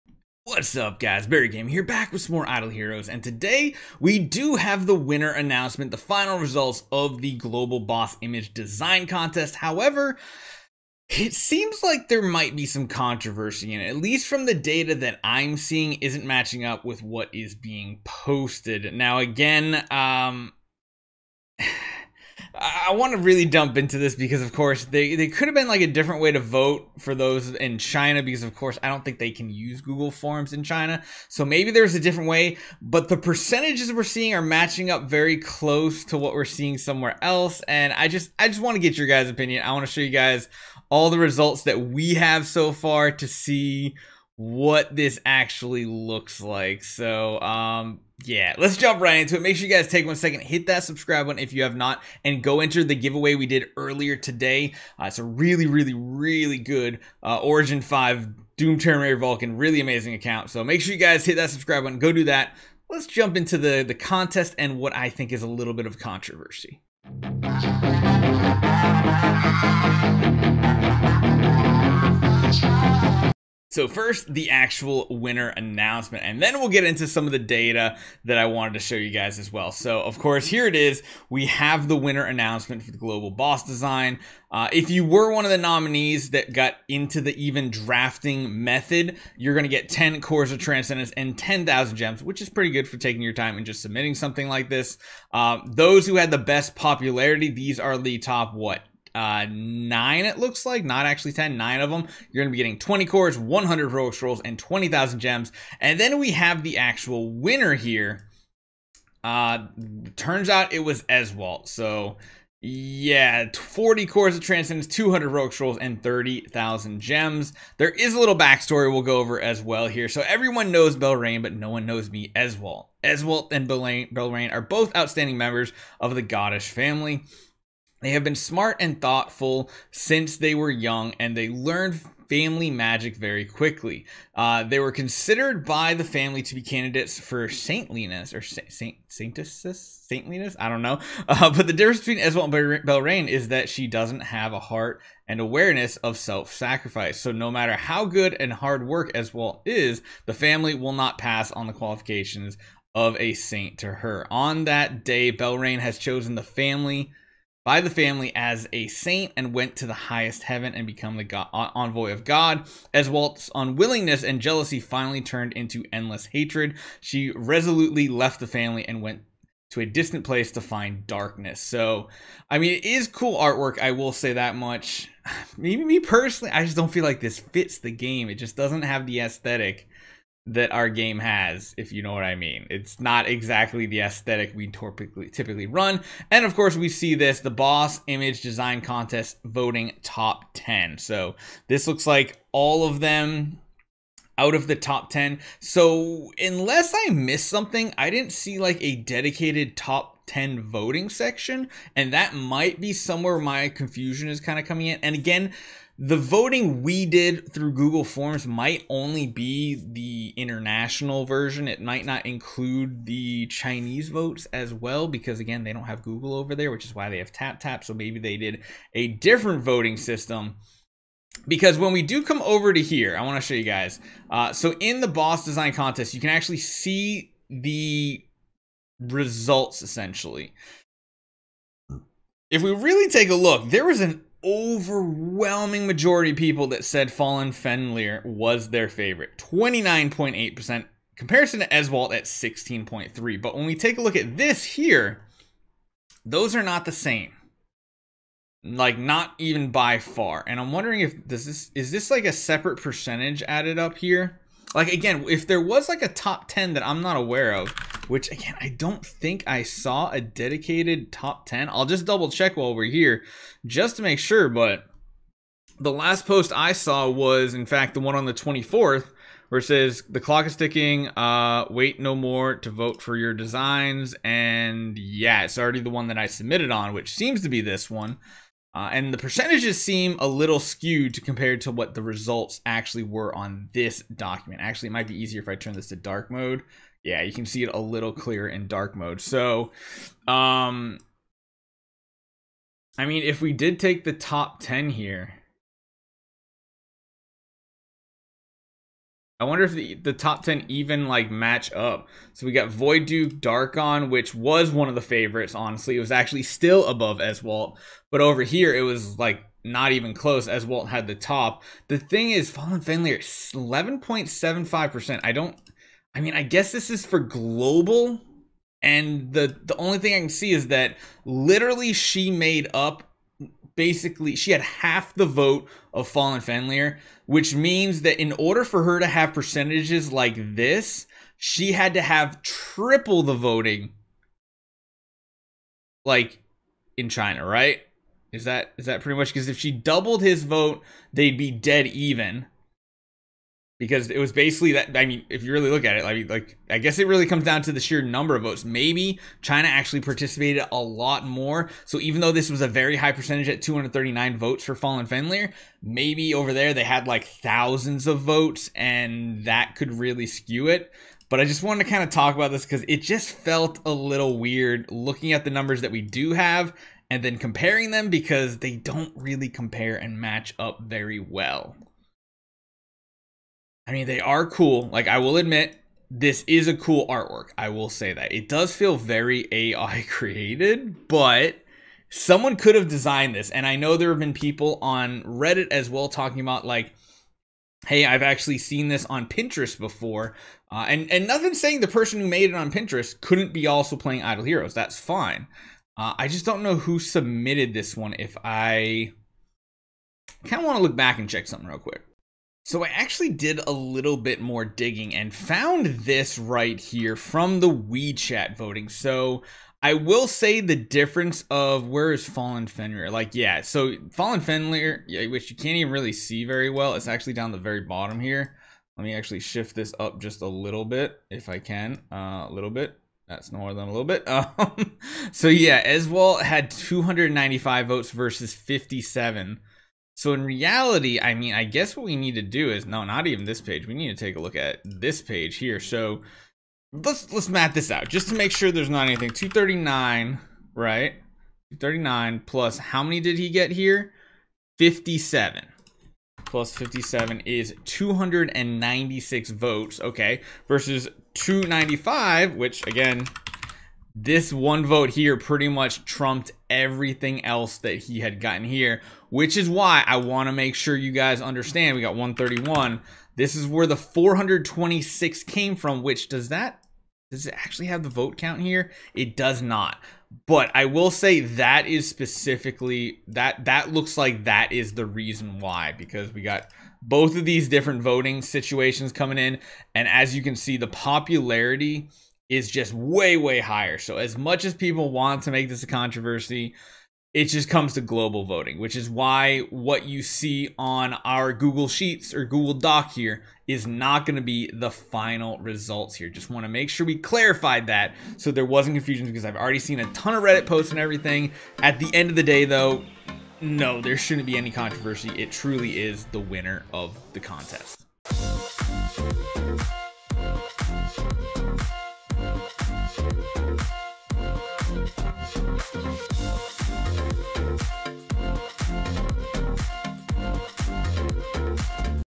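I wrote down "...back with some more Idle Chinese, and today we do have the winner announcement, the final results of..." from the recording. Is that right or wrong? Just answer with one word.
wrong.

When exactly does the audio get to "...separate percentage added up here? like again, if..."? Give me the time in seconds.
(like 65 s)
252 s.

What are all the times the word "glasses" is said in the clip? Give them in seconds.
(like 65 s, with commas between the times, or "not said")
not said.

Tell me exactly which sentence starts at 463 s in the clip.
This is where the 426 came from, which does that, does it actually have the vote count here?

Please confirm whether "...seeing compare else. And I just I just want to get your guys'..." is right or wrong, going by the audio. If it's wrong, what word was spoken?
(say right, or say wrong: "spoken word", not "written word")
wrong: "somewhere", not "compare".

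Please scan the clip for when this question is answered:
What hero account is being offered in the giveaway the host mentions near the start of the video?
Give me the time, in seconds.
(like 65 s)
57 s.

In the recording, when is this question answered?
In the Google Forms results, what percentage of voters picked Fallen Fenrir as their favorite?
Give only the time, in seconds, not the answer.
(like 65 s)
239 s.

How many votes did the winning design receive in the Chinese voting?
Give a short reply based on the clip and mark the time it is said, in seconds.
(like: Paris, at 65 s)
295, at 426 s.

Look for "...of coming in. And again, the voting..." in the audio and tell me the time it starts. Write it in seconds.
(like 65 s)
204 s.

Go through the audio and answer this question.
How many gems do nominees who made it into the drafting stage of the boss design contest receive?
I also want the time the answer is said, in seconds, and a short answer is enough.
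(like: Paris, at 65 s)
10,000, at 91 s.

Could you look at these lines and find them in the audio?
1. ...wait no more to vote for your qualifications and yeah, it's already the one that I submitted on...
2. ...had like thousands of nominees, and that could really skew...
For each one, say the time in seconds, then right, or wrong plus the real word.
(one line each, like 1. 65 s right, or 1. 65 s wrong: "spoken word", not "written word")
1. 271 s wrong: "designs", not "qualifications"
2. 356 s wrong: "votes", not "nominees".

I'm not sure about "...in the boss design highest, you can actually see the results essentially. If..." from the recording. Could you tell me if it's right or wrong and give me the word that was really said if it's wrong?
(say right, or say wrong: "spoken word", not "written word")
wrong: "contest", not "highest".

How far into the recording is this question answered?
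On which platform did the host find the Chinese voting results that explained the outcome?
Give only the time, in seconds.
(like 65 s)
407 s.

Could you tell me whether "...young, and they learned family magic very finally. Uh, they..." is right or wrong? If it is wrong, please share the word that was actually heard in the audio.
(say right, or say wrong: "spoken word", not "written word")
wrong: "quickly", not "finally".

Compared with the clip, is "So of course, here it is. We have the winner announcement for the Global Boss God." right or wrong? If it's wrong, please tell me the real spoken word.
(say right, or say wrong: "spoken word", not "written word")
wrong: "Design", not "God".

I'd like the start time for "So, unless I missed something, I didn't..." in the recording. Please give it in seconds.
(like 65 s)
195 s.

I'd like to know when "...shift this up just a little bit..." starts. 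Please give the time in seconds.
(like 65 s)
419 s.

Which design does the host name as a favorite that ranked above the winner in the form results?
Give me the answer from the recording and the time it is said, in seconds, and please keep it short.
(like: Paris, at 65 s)
Void Duke, Darkon, at 302 s.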